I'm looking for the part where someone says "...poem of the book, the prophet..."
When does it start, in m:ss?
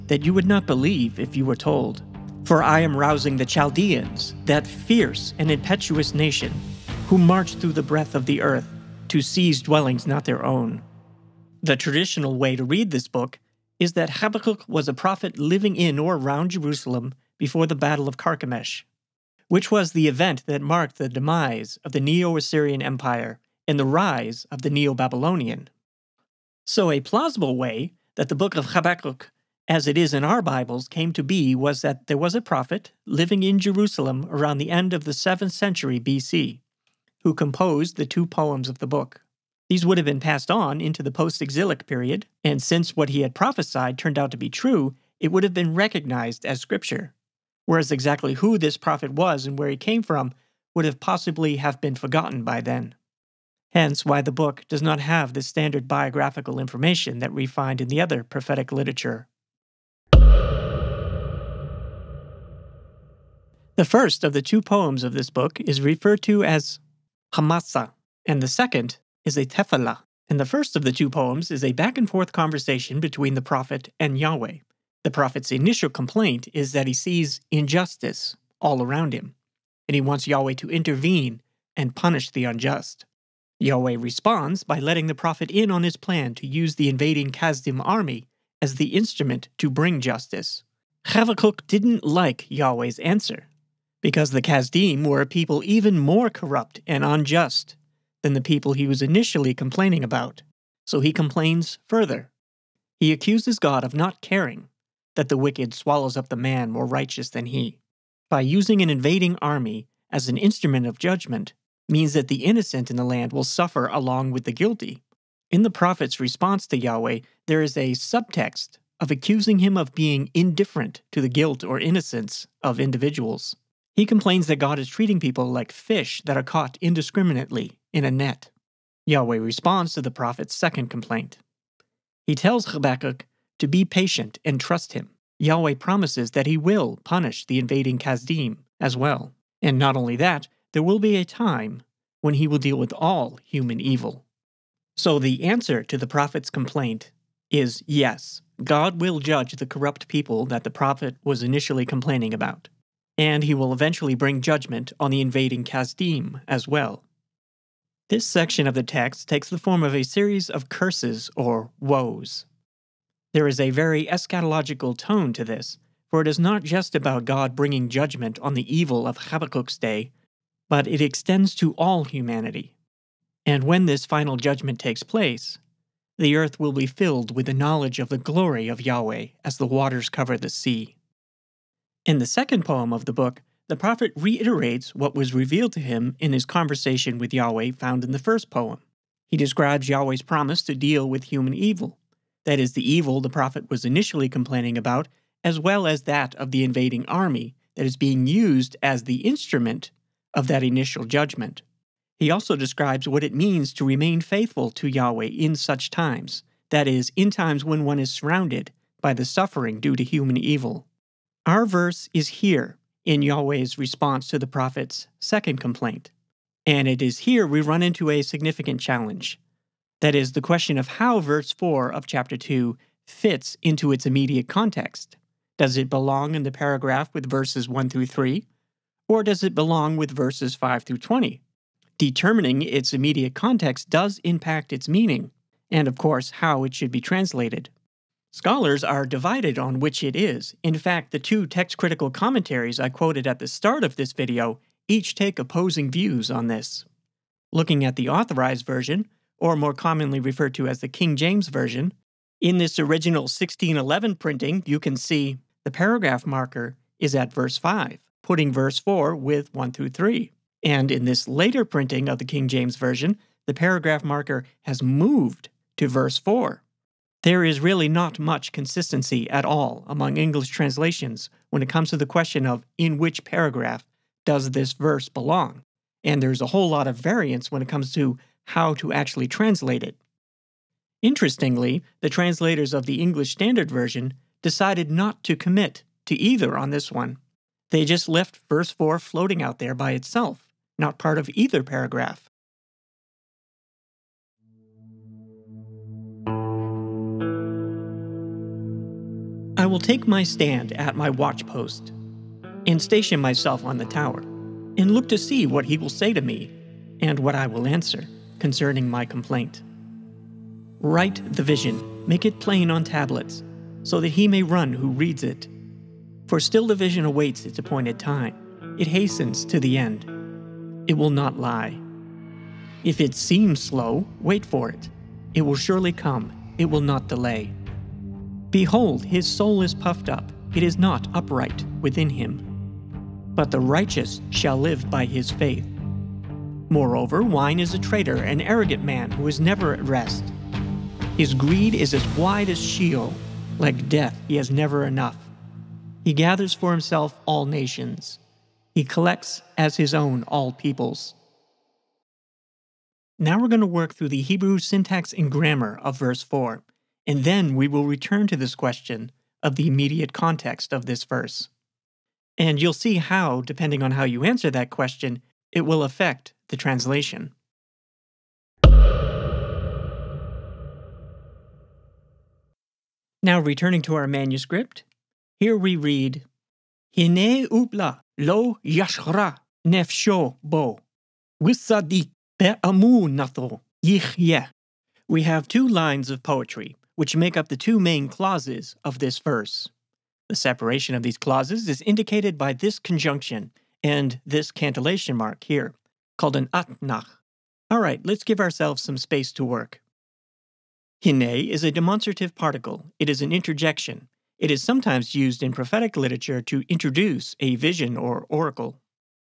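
3:02.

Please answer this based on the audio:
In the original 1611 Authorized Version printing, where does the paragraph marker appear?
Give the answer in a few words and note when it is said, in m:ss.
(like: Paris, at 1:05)
Verse 5, at 4:17.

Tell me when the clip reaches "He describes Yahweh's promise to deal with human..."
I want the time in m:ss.
3:09.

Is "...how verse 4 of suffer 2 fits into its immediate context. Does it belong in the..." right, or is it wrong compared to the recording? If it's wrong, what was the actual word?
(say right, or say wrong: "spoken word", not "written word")
wrong: "chapter", not "suffer".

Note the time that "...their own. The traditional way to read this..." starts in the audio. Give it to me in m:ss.
0:10.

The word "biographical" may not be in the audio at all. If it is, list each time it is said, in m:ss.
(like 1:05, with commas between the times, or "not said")
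0:55.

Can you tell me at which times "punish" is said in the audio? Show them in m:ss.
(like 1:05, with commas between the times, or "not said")
1:21, 2:17.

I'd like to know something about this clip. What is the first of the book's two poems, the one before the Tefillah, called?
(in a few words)
Hamasa.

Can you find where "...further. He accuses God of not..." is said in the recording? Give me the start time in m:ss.
1:41.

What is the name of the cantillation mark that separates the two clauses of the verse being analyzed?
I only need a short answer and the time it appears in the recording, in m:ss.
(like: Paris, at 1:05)
Atnach, at 6:36.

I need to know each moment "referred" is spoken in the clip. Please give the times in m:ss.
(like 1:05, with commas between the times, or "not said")
1:05, 4:10.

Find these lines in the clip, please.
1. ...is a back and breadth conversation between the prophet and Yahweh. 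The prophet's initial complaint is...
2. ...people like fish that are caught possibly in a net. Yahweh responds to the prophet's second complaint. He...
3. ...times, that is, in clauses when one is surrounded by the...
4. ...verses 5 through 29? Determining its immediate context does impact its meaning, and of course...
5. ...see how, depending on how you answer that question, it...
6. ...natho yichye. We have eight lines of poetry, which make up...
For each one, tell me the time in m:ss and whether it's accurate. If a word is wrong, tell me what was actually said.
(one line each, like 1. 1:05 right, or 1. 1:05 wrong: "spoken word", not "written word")
1. 1:11 wrong: "forth", not "breadth"
2. 2:05 wrong: "indiscriminately", not "possibly"
3. 3:25 wrong: "times", not "clauses"
4. 3:50 wrong: "20", not "29"
5. 6:02 right
6. 6:23 wrong: "two", not "eight".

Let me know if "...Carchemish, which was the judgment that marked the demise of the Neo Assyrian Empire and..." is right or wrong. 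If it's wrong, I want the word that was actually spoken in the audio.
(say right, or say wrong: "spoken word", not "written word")
wrong: "event", not "judgment".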